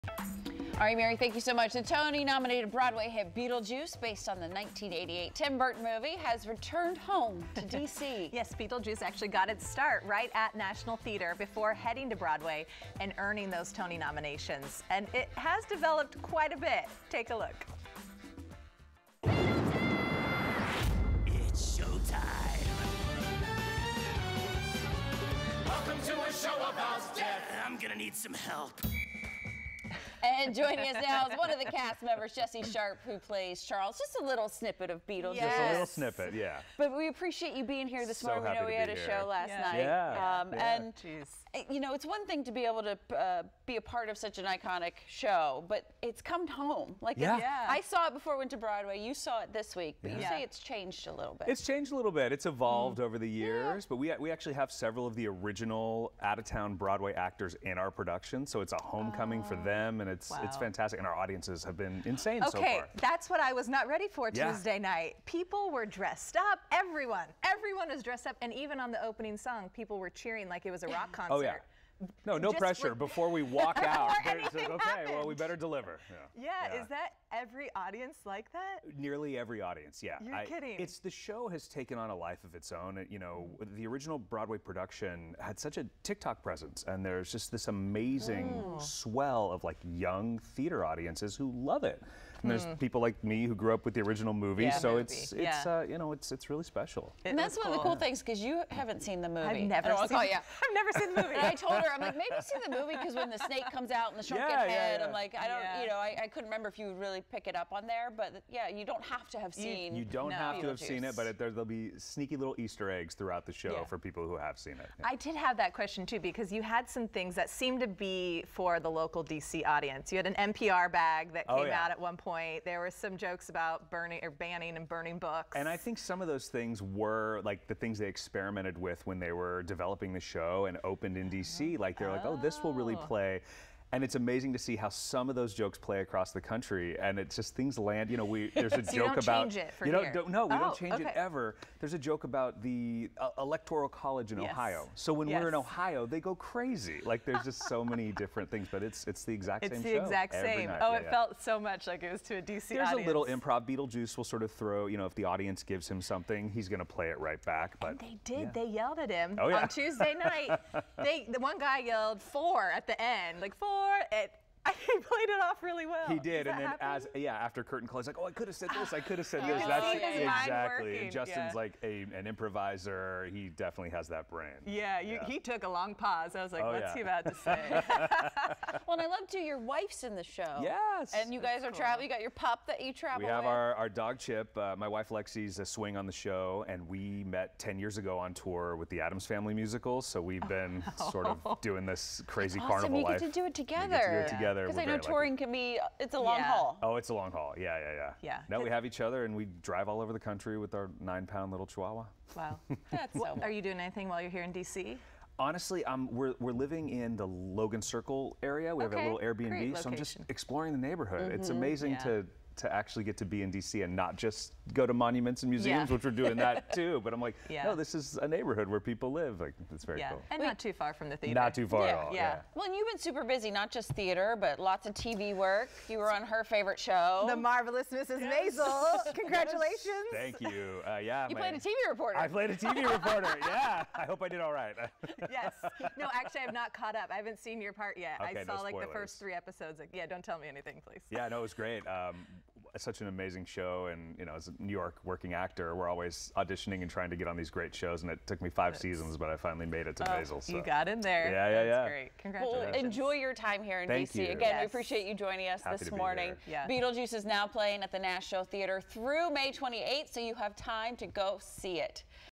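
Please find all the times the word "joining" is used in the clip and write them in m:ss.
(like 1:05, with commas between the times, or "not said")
0:30, 4:15.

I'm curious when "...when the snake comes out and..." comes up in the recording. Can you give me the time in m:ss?
1:43.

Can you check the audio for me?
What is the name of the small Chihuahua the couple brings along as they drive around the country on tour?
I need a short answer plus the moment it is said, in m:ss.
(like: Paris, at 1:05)
Chip, at 3:04.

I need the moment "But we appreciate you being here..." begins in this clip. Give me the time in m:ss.
0:36.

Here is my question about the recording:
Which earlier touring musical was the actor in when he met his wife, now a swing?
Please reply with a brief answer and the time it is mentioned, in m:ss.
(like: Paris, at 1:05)
The Addams Family, at 3:09.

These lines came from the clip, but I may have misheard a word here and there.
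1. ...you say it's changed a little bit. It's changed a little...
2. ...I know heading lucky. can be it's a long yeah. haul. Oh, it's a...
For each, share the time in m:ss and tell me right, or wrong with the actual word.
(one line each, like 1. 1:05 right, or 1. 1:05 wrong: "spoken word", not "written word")
1. 0:50 right
2. 3:14 wrong: "touring", not "heading".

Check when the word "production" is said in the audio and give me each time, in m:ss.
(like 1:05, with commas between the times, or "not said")
0:57, 1:24.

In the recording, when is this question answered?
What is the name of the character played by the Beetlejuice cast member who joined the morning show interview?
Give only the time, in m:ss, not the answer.
0:33.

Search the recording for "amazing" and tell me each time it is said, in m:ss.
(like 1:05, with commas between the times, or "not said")
1:27, 2:14, 3:31, 4:03.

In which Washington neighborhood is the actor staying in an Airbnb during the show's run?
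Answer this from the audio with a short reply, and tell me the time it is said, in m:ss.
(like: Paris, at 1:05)
Logan Circle, at 3:27.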